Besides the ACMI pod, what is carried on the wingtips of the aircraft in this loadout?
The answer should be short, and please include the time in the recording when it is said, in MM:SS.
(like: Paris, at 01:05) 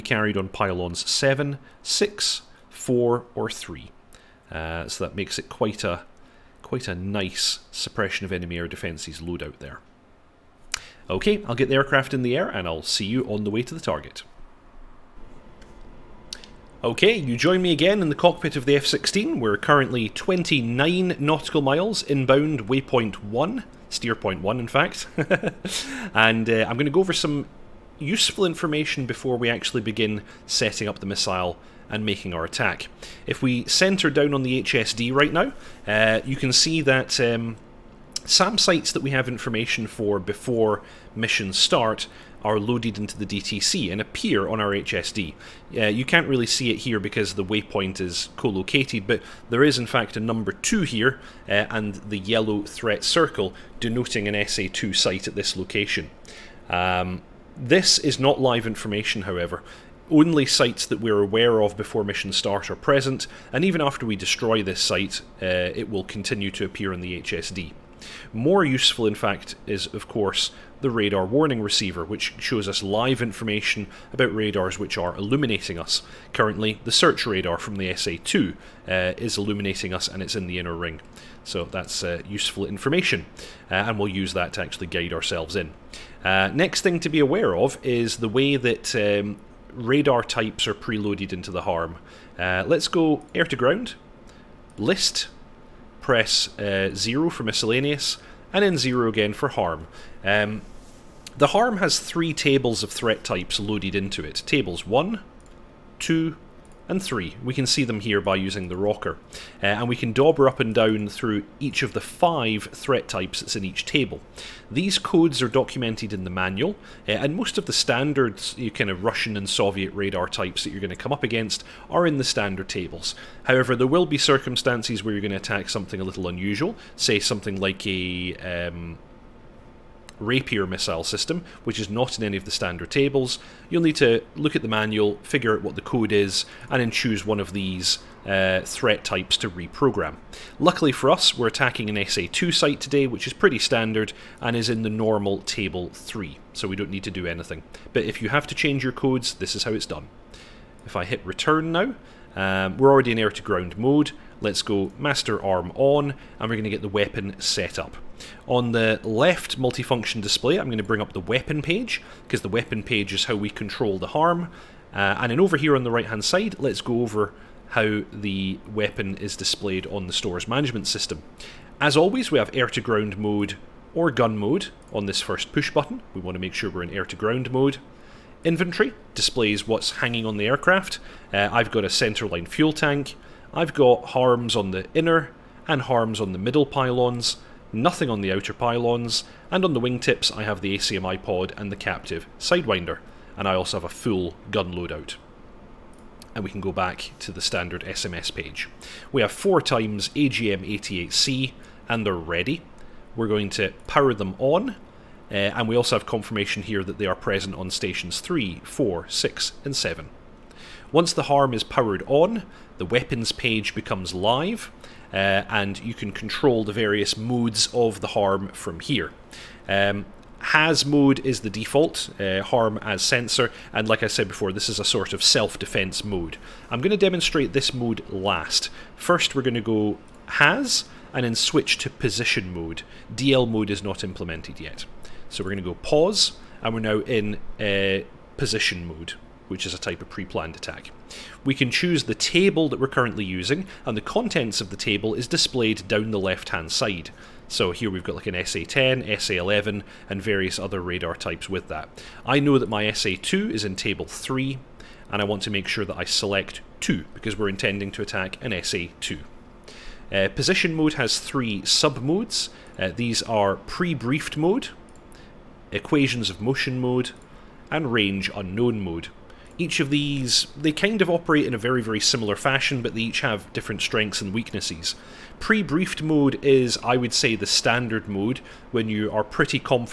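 Captive Sidewinder, at 03:11.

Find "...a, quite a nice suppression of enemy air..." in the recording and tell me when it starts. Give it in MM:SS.
00:05.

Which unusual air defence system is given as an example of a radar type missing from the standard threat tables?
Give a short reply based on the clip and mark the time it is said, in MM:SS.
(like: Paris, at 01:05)
Rapier, at 02:10.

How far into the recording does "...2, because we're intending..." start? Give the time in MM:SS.
04:16.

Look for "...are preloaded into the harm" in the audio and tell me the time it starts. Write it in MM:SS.
01:30.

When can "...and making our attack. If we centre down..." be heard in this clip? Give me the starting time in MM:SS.
00:31.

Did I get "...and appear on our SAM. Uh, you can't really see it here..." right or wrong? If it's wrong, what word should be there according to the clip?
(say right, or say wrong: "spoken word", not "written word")
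wrong: "HSD", not "SAM".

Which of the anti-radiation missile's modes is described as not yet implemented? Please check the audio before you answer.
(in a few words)
DL mode.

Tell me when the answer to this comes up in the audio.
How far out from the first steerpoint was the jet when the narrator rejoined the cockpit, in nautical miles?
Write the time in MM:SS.
00:20.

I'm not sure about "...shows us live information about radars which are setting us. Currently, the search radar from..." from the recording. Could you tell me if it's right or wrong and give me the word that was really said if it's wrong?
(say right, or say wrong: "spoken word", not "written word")
wrong: "illuminating", not "setting".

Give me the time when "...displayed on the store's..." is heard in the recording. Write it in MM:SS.
02:49.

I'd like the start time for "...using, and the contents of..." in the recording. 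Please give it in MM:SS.
04:03.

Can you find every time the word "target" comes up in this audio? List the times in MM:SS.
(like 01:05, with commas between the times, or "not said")
00:13.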